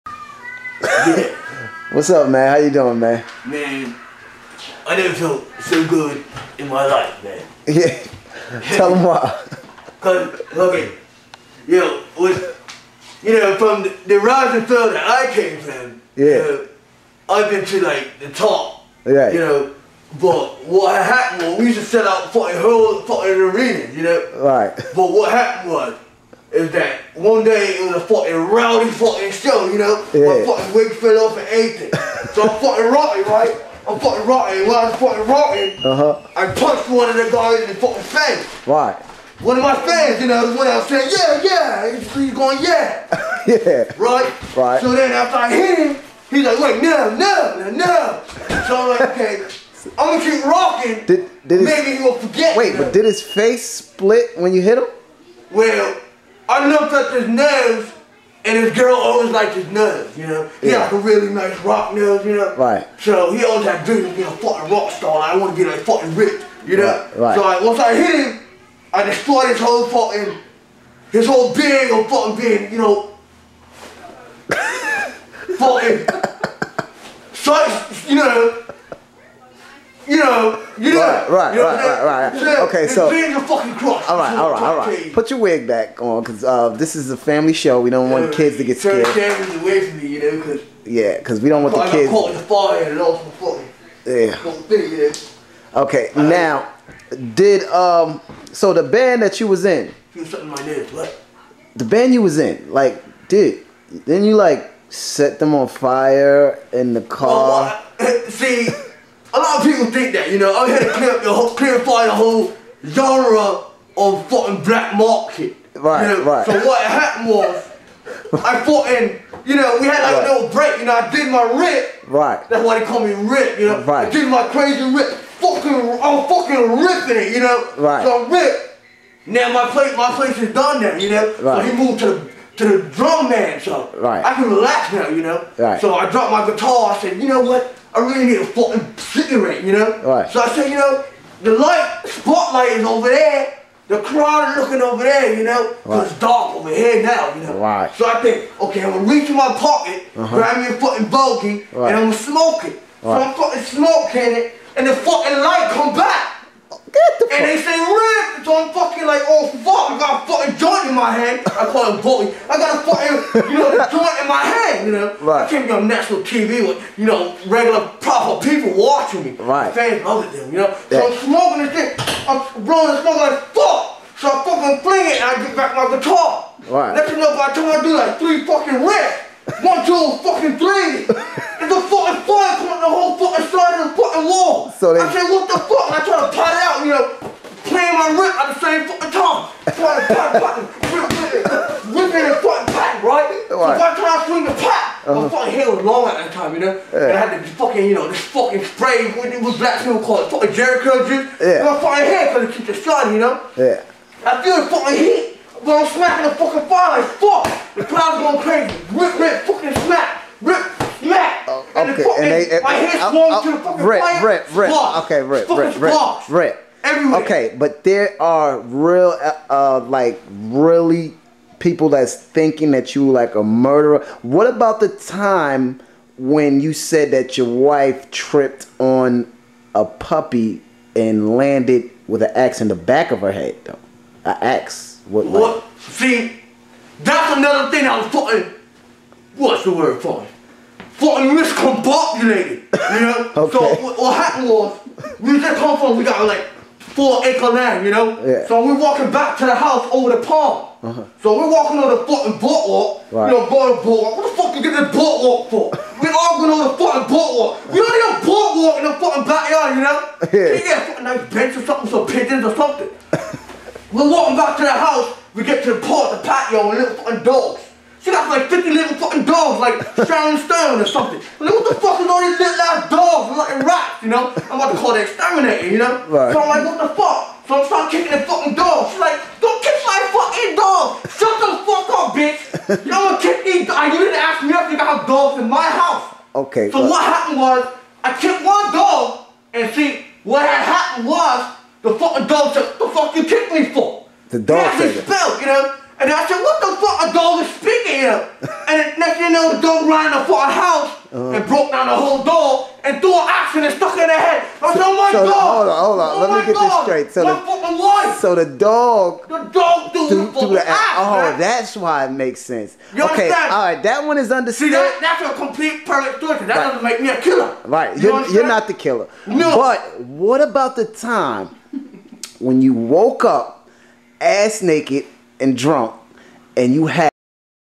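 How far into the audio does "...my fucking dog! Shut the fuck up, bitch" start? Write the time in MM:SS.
04:39.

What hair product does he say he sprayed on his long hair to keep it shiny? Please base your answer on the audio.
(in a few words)
Jheri curl juice.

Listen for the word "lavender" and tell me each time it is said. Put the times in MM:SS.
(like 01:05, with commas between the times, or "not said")
not said.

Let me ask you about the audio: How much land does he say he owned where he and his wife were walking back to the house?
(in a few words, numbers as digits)
4 acres.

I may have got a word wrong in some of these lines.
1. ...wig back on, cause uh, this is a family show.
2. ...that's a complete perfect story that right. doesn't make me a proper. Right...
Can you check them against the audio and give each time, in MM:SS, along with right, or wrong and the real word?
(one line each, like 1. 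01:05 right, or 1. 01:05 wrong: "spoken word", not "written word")
1. 01:25 right
2. 05:15 wrong: "killer", not "proper".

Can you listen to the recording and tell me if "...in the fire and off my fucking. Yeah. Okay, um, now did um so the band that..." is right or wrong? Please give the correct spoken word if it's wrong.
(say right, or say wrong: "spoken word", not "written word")
right.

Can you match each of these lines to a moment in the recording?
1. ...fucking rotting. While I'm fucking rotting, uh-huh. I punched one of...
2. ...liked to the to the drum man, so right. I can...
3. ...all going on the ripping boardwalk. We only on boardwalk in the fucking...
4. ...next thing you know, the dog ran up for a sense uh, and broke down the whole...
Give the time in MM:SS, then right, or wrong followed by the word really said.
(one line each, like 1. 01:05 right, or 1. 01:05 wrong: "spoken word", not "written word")
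1. 00:33 right
2. 02:11 wrong: "moved", not "liked"
3. 04:16 wrong: "fucking", not "ripping"
4. 04:58 wrong: "house", not "sense".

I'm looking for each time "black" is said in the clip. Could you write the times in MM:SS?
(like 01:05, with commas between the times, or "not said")
01:54, 03:19.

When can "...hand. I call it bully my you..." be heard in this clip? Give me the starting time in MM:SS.
02:41.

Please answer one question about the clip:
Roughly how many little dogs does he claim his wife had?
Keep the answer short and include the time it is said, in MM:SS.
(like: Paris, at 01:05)
50, at 04:28.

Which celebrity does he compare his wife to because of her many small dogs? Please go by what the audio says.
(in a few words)
Sharon Stone.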